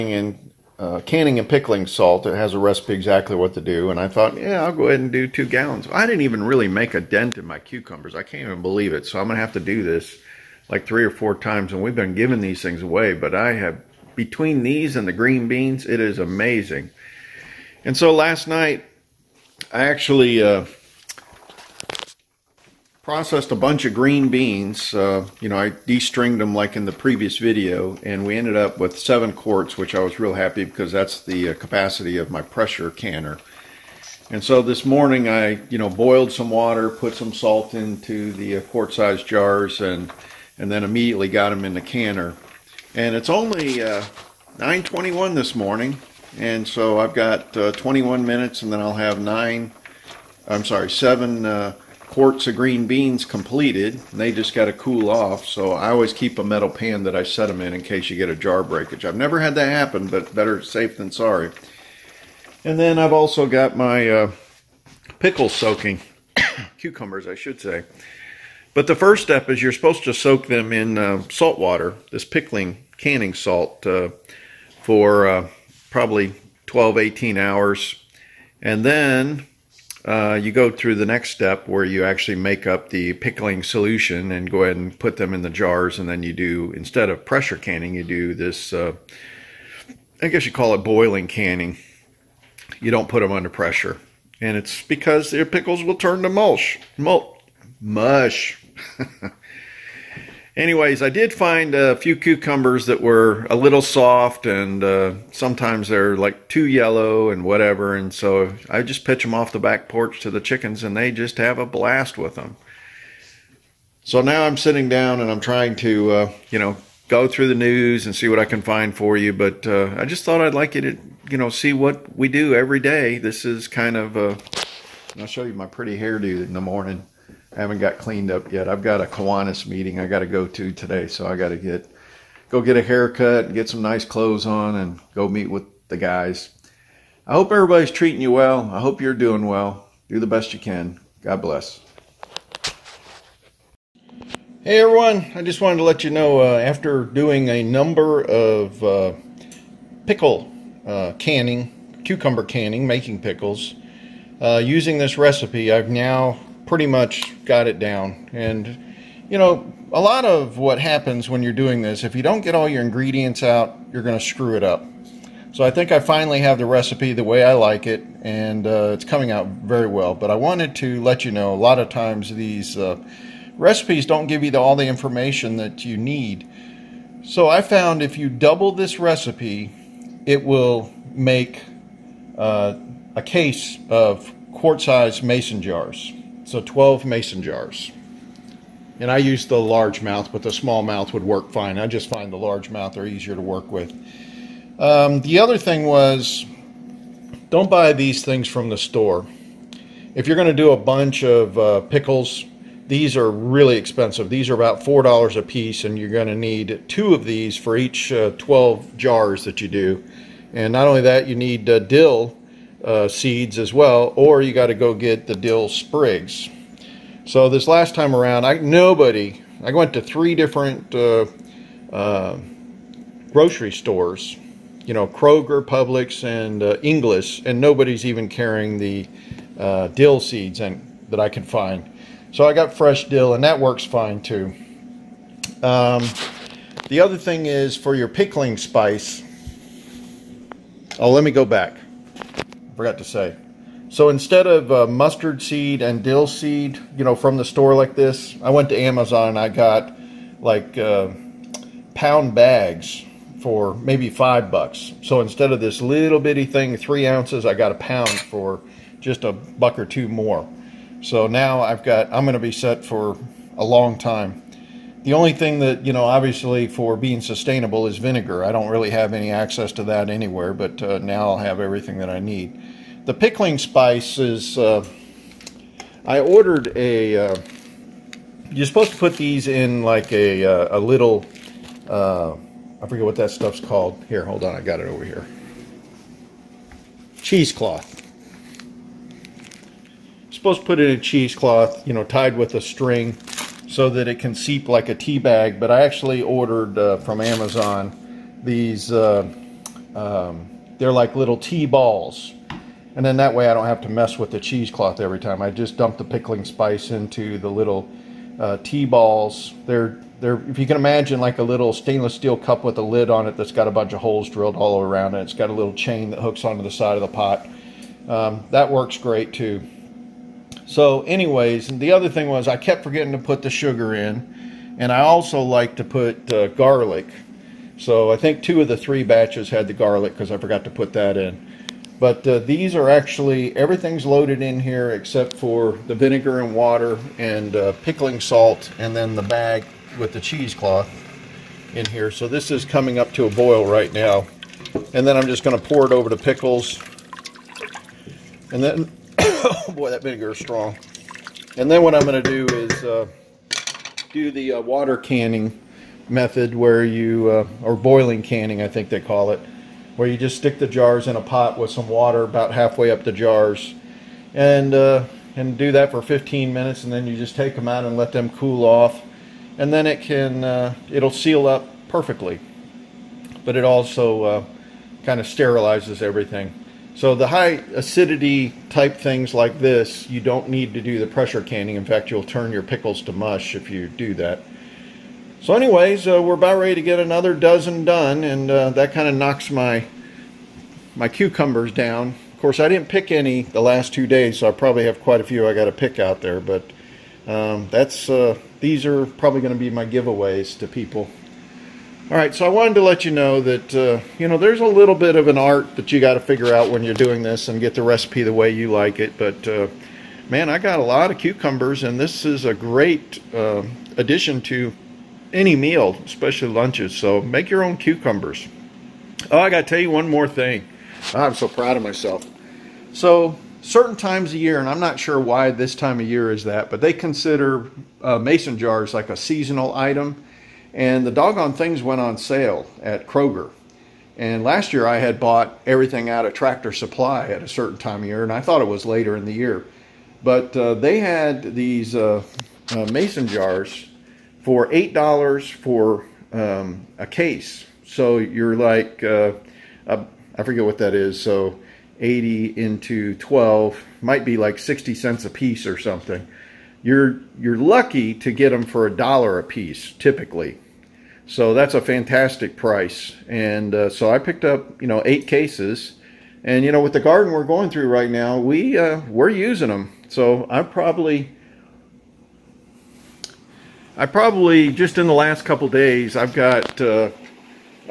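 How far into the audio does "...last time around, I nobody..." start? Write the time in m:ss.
3:37.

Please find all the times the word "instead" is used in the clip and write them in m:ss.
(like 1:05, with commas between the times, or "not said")
1:26, 4:04, 4:15.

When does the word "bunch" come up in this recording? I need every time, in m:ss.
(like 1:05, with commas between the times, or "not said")
0:23, 3:20, 5:13.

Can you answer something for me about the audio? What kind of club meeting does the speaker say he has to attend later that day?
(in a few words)
Kiwanis.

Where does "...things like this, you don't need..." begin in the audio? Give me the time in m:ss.
6:18.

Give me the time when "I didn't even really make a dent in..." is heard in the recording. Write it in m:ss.
0:05.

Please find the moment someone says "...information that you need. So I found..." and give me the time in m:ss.
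2:54.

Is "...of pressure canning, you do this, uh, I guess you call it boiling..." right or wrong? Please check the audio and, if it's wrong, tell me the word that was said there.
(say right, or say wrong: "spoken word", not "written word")
right.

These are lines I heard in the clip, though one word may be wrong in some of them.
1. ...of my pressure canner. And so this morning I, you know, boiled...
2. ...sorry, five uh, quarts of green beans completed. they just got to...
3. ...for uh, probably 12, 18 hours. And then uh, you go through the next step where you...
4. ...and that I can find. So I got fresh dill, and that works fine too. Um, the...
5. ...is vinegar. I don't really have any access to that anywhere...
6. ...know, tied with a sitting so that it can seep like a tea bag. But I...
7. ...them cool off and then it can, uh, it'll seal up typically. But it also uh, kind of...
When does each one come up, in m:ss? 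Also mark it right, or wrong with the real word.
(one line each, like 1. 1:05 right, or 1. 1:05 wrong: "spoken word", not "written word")
1. 0:32 right
2. 0:50 wrong: "seven", not "five"
3. 1:14 right
4. 3:50 right
5. 4:27 right
6. 4:51 wrong: "string", not "sitting"
7. 6:08 wrong: "perfectly", not "typically".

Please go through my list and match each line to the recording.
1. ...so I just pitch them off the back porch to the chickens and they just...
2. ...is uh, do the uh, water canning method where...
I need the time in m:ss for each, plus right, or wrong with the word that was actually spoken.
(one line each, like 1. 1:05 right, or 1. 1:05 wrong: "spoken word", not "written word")
1. 1:48 right
2. 5:52 right.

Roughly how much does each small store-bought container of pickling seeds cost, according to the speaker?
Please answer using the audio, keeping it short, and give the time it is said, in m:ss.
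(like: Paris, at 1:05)
$4, at 3:24.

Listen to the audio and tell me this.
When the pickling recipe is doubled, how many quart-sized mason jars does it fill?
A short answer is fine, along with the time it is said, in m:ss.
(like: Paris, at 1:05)
12, at 3:06.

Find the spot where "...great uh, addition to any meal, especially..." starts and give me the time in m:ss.
6:52.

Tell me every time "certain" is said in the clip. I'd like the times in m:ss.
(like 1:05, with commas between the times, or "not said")
7:03, 7:17.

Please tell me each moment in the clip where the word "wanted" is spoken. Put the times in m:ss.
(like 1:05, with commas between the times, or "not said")
2:25, 2:50, 6:42.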